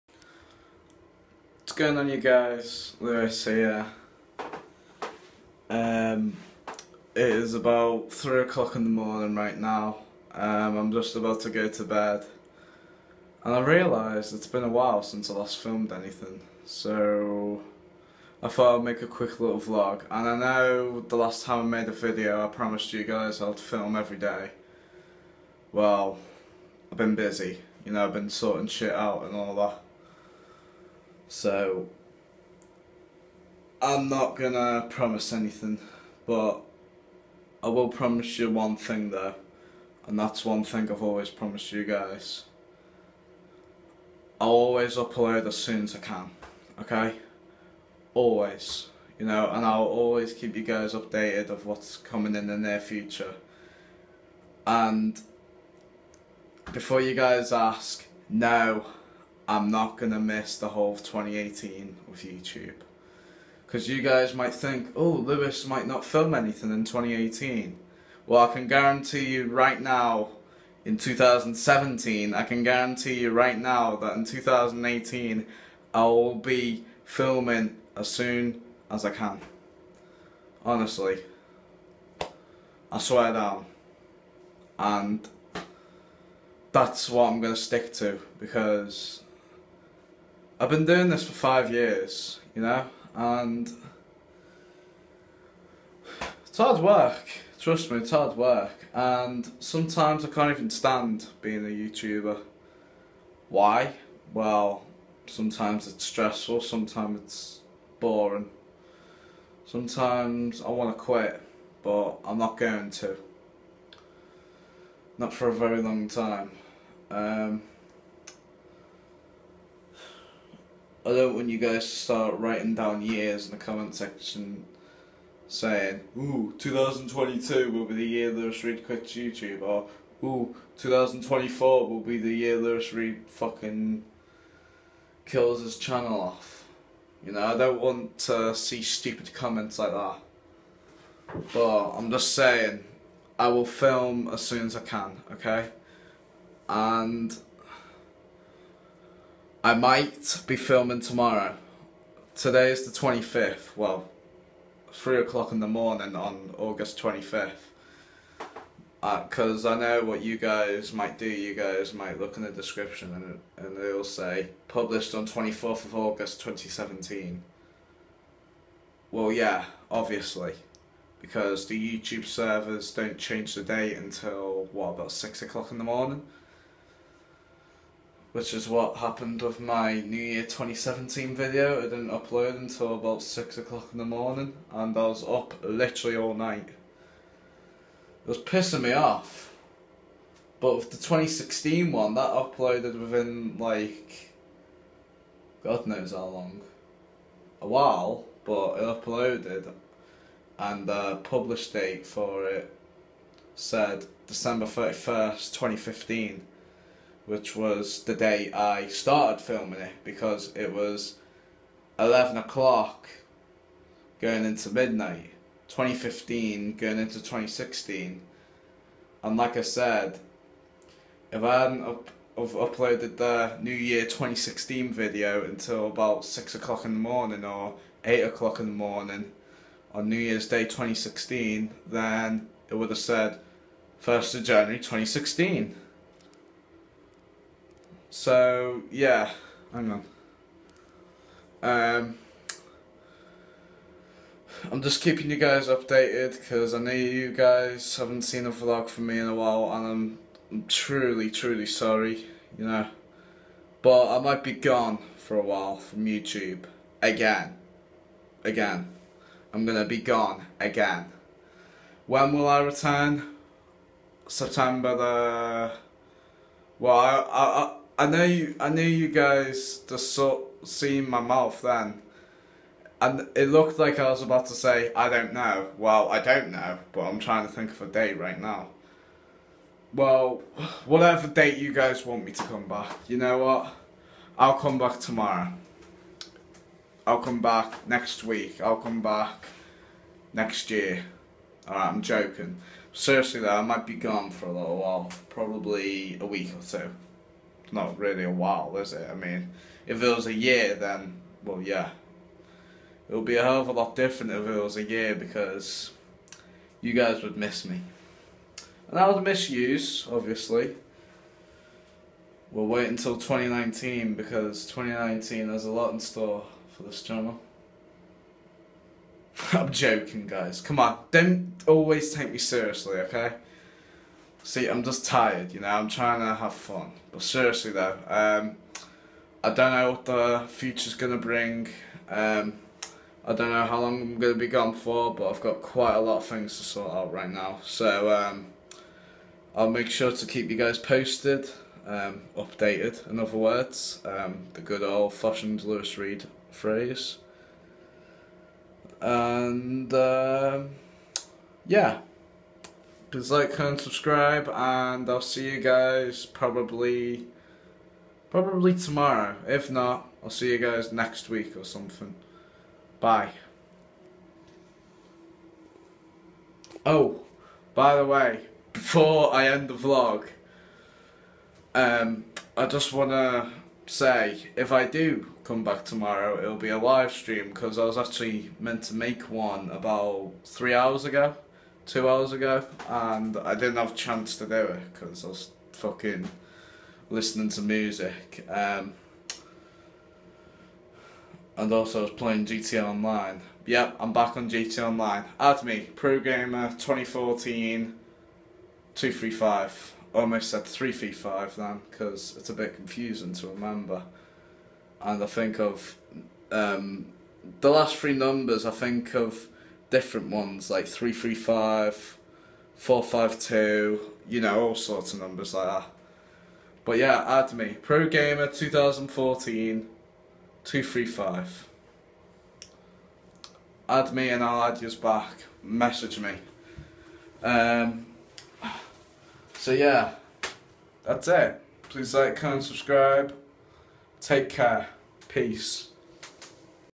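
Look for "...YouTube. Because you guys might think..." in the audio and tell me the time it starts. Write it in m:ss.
1:02.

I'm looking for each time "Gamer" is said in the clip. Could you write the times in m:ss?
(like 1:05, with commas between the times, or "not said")
6:36, 6:58.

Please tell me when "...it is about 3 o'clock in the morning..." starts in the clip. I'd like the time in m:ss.
0:07.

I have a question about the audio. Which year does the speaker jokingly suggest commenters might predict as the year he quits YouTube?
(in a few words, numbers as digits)
2022.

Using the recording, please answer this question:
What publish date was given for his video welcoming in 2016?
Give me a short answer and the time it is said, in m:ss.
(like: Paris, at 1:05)
December 31st, 2015, at 3:24.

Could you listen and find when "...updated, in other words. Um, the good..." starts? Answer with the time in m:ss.
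5:42.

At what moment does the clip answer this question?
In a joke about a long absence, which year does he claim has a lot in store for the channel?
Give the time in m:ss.
5:14.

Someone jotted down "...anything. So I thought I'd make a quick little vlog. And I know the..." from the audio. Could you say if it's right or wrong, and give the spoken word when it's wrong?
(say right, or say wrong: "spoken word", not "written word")
right.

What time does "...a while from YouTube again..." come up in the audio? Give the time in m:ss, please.
4:15.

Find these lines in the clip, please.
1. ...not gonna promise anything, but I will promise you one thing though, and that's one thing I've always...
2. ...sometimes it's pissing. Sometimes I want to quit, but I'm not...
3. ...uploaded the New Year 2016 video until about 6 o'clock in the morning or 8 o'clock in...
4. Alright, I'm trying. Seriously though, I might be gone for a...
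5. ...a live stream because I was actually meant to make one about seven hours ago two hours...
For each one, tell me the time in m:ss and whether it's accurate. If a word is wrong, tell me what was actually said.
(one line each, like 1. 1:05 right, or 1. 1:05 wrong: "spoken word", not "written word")
1. 0:34 right
2. 1:46 wrong: "boring", not "pissing"
3. 3:42 right
4. 4:51 wrong: "joking", not "trying"
5. 6:16 wrong: "three", not "seven".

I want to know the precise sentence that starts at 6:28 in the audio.
Um, and also I was playing GTA Online.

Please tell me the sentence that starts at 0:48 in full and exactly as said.
Always, you know, and I'll always keep you guys updated of what's coming in the near future.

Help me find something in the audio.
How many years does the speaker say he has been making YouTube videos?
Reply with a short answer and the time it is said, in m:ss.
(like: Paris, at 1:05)
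5 years, at 1:31.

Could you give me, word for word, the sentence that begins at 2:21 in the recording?
But I'm just saying, I will film as soon as I can, okay?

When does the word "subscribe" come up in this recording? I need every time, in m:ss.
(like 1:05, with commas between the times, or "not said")
5:53, 7:12.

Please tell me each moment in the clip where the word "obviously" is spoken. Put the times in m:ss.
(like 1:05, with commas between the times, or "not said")
2:49, 5:10.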